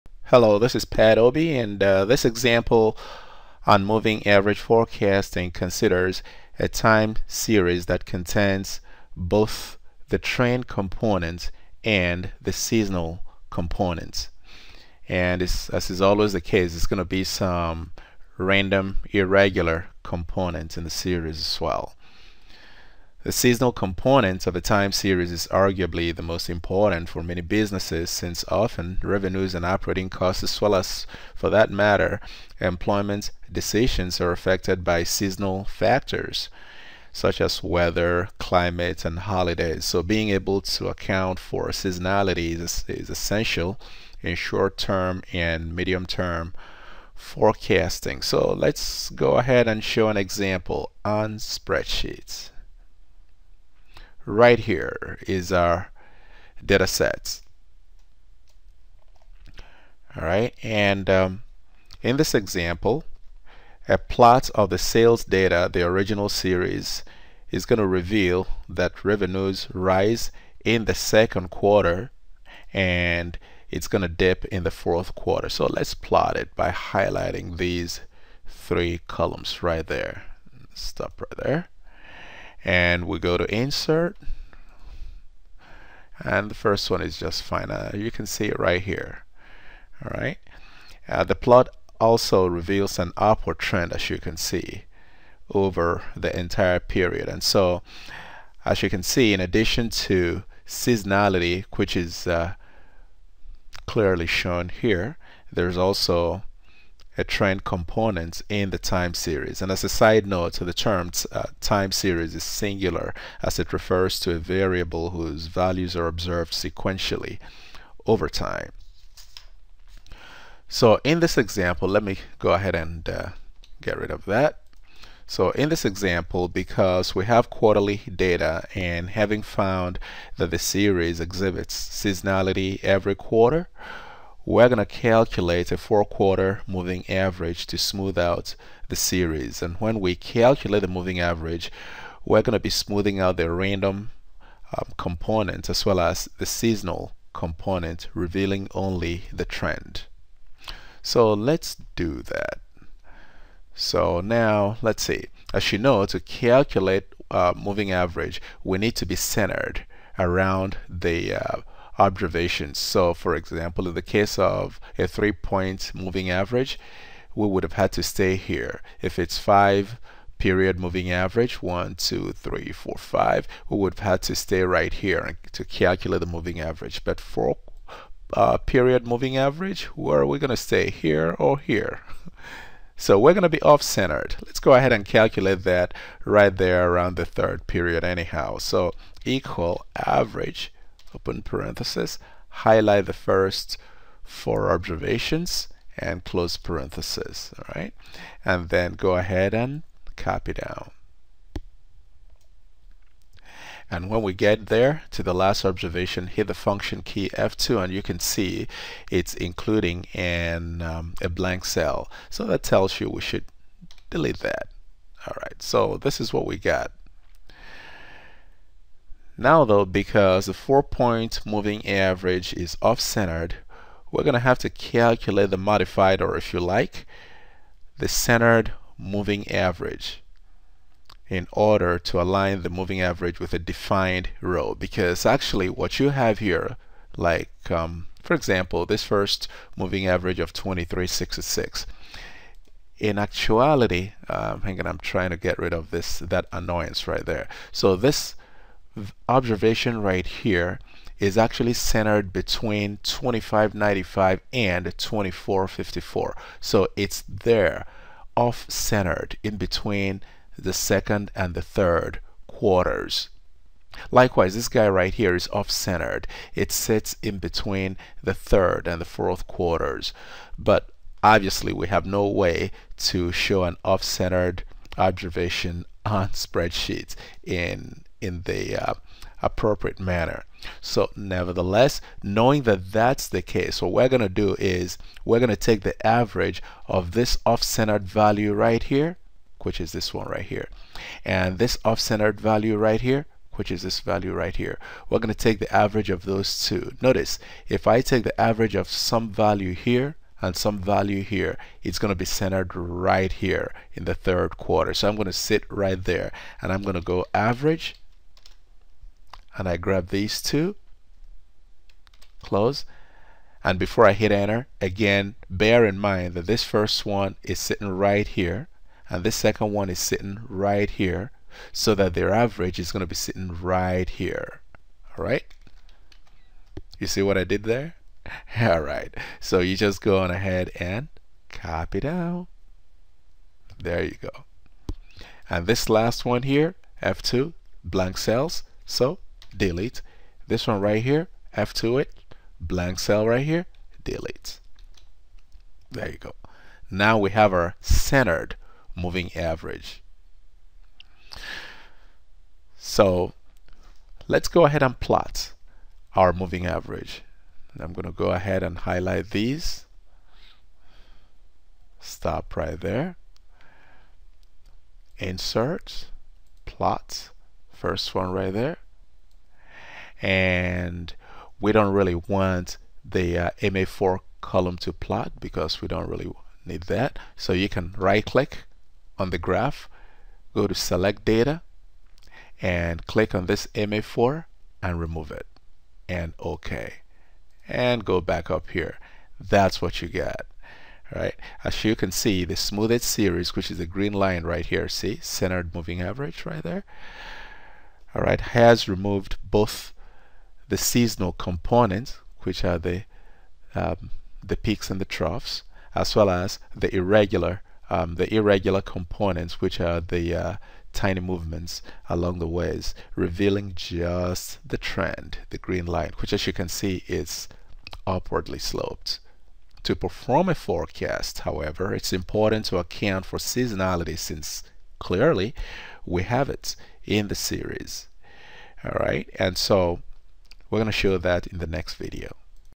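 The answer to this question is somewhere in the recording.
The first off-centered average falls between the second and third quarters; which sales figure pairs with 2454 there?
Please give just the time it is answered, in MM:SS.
04:13.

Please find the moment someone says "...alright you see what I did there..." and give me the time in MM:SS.
05:25.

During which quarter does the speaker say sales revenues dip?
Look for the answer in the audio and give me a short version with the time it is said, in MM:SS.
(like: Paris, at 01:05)
fourth quarter, at 01:14.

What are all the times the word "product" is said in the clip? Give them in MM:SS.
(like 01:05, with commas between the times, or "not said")
not said.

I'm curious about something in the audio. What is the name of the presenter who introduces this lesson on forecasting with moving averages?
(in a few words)
Pat Obi.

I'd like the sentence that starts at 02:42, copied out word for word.
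So for example, in the case of a three point moving average, we would have had to stay here.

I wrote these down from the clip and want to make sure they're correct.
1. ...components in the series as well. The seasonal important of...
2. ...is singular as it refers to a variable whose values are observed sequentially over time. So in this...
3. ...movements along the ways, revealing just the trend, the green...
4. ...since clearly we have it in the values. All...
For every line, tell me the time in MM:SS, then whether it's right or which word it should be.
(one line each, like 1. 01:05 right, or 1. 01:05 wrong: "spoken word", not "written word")
1. 00:20 wrong: "component", not "important"
2. 01:52 right
3. 06:51 right
4. 07:04 wrong: "series", not "values".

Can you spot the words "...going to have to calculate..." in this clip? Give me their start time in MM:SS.
03:44.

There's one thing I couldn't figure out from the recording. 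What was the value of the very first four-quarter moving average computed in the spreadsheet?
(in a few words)
2366.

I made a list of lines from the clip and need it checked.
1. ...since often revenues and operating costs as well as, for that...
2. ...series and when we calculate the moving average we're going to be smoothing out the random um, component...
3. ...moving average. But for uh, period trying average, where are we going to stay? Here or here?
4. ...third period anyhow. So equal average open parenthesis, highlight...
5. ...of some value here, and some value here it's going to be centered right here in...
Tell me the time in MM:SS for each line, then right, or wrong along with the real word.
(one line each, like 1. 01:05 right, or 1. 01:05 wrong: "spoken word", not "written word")
1. 00:28 right
2. 02:18 right
3. 02:56 wrong: "moving", not "trying"
4. 03:07 right
5. 04:58 right.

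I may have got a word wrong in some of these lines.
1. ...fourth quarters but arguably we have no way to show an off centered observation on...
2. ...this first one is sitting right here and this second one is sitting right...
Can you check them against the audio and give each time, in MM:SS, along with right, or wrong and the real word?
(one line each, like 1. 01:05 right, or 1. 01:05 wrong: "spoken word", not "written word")
1. 04:29 wrong: "obviously", not "arguably"
2. 05:16 right.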